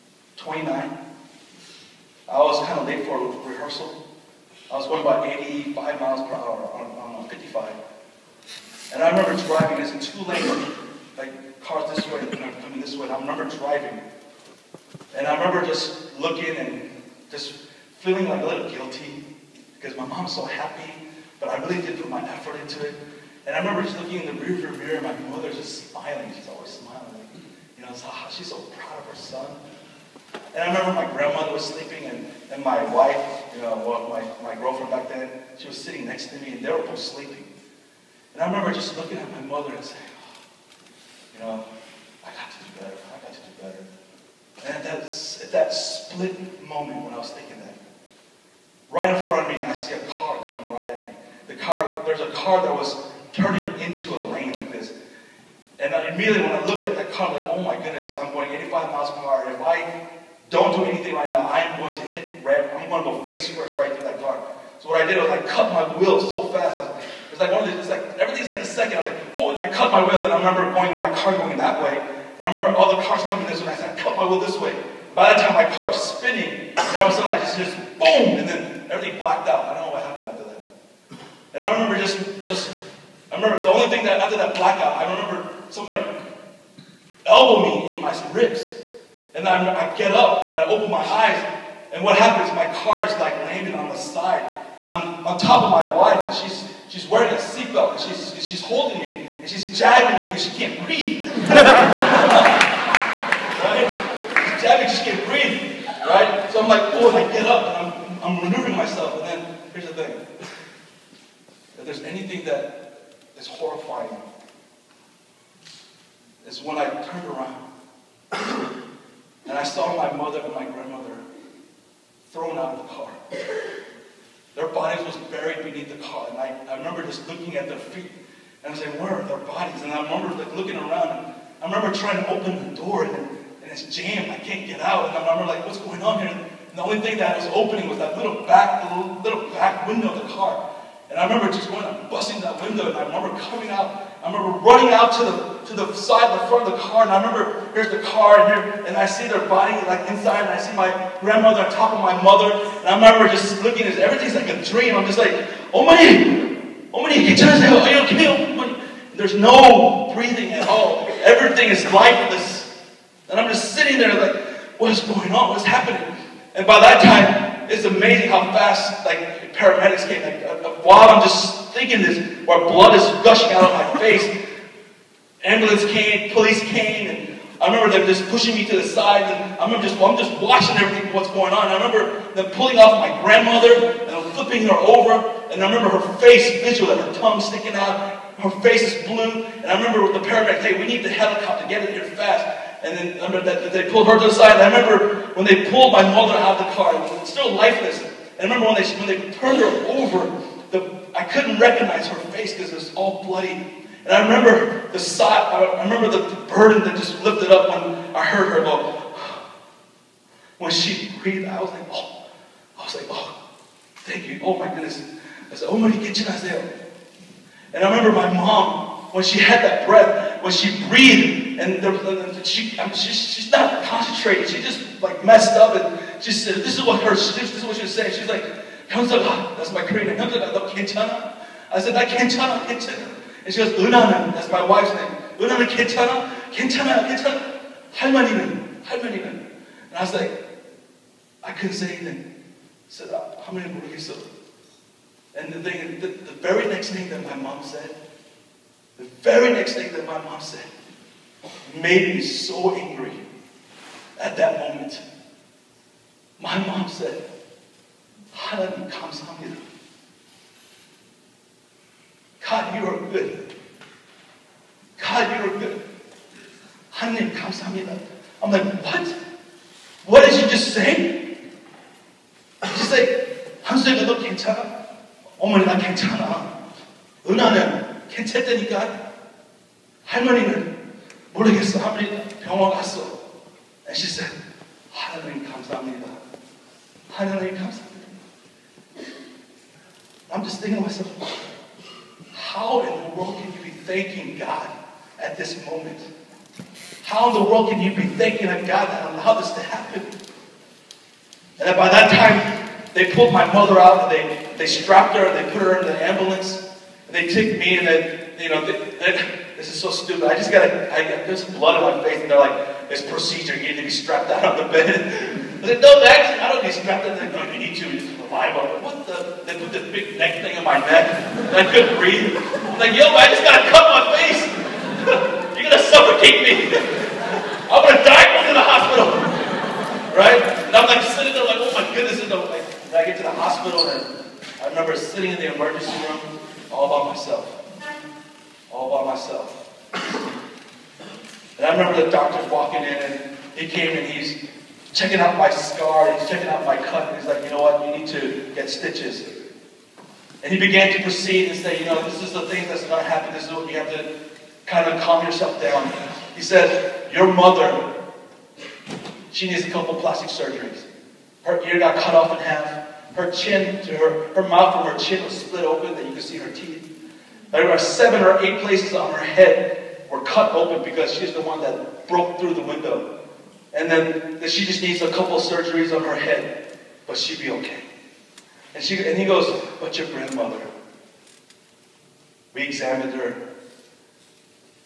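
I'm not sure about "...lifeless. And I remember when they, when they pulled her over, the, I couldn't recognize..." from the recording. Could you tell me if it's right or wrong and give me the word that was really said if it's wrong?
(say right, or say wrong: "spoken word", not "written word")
wrong: "turned", not "pulled".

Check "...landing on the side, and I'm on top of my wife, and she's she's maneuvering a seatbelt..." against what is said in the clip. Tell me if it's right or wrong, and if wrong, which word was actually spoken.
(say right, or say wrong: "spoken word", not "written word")
wrong: "wearing", not "maneuvering".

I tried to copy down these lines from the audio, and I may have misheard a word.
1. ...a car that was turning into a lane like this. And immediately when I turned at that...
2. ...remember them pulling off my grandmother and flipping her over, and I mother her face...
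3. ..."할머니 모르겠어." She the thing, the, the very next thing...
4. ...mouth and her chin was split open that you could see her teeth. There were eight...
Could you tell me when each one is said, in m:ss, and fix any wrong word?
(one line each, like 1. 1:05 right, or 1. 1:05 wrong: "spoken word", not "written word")
1. 0:52 wrong: "looked", not "turned"
2. 3:01 wrong: "remember", not "mother"
3. 4:03 wrong: "And", not "She"
4. 6:04 wrong: "seven", not "eight".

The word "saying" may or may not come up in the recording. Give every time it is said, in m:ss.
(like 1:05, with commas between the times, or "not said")
0:39, 3:47.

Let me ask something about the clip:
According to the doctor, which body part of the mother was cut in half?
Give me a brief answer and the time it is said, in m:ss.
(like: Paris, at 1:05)
Her ear, at 6:01.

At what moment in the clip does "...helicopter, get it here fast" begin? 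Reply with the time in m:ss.
3:11.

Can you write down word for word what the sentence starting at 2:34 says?
I'm just like, oh my, oh my, get oh okay, There's no breathing at all.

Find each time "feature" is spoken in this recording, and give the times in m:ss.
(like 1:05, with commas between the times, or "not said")
not said.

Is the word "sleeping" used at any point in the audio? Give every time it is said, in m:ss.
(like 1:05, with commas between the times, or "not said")
0:31, 0:36.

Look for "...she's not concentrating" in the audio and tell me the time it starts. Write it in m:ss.
3:43.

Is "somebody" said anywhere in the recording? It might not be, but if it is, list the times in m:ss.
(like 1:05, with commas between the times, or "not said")
1:25.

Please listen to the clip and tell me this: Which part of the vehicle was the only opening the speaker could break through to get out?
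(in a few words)
little back window.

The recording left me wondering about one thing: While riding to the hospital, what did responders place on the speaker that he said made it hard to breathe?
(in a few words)
big neck thing.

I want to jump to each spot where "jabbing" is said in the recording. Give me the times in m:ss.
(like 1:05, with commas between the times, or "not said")
1:39, 1:44.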